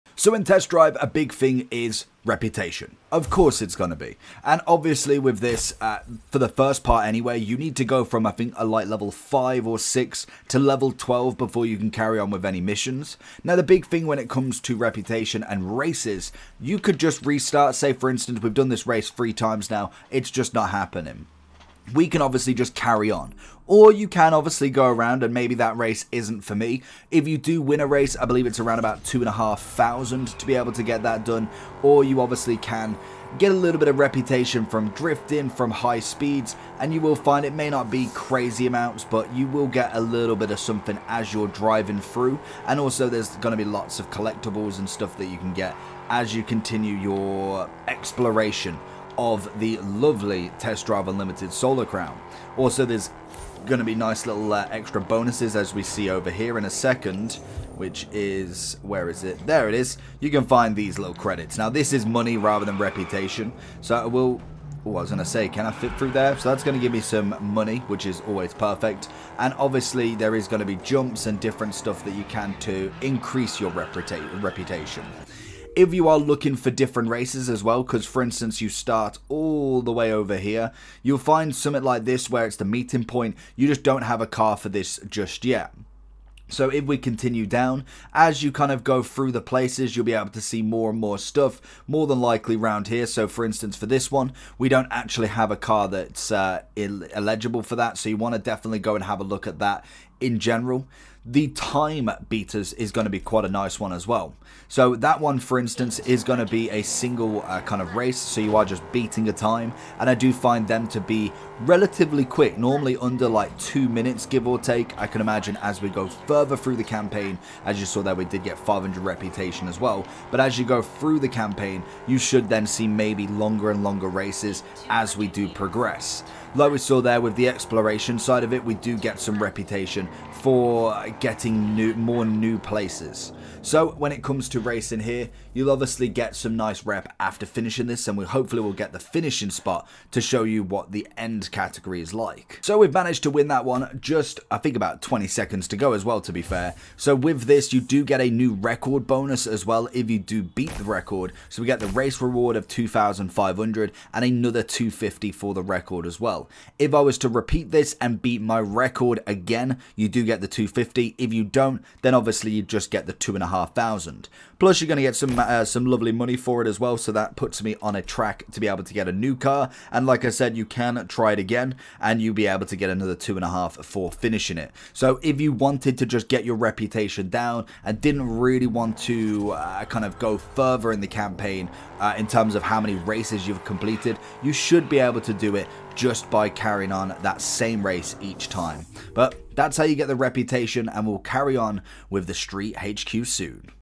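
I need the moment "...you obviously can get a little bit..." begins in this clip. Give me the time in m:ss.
0:32.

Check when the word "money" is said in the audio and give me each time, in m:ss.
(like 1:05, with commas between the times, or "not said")
1:02, 1:07, 2:46.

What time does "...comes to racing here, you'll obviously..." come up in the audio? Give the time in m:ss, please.
2:14.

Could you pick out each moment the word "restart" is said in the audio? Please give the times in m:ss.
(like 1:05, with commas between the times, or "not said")
0:17.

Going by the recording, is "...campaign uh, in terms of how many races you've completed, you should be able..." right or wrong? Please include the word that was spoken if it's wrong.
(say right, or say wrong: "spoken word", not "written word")
right.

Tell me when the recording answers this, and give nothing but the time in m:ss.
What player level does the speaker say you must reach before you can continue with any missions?
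0:10.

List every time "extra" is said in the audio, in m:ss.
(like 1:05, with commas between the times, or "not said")
0:54.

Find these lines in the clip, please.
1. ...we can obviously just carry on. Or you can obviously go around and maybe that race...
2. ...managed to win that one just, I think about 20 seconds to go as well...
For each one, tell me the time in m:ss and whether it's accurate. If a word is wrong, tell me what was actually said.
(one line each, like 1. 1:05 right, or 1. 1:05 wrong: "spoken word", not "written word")
1. 0:21 right
2. 2:22 right.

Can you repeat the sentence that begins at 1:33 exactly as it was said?
So for instance, for this one, we don't actually have a car that's uh, eligible for that.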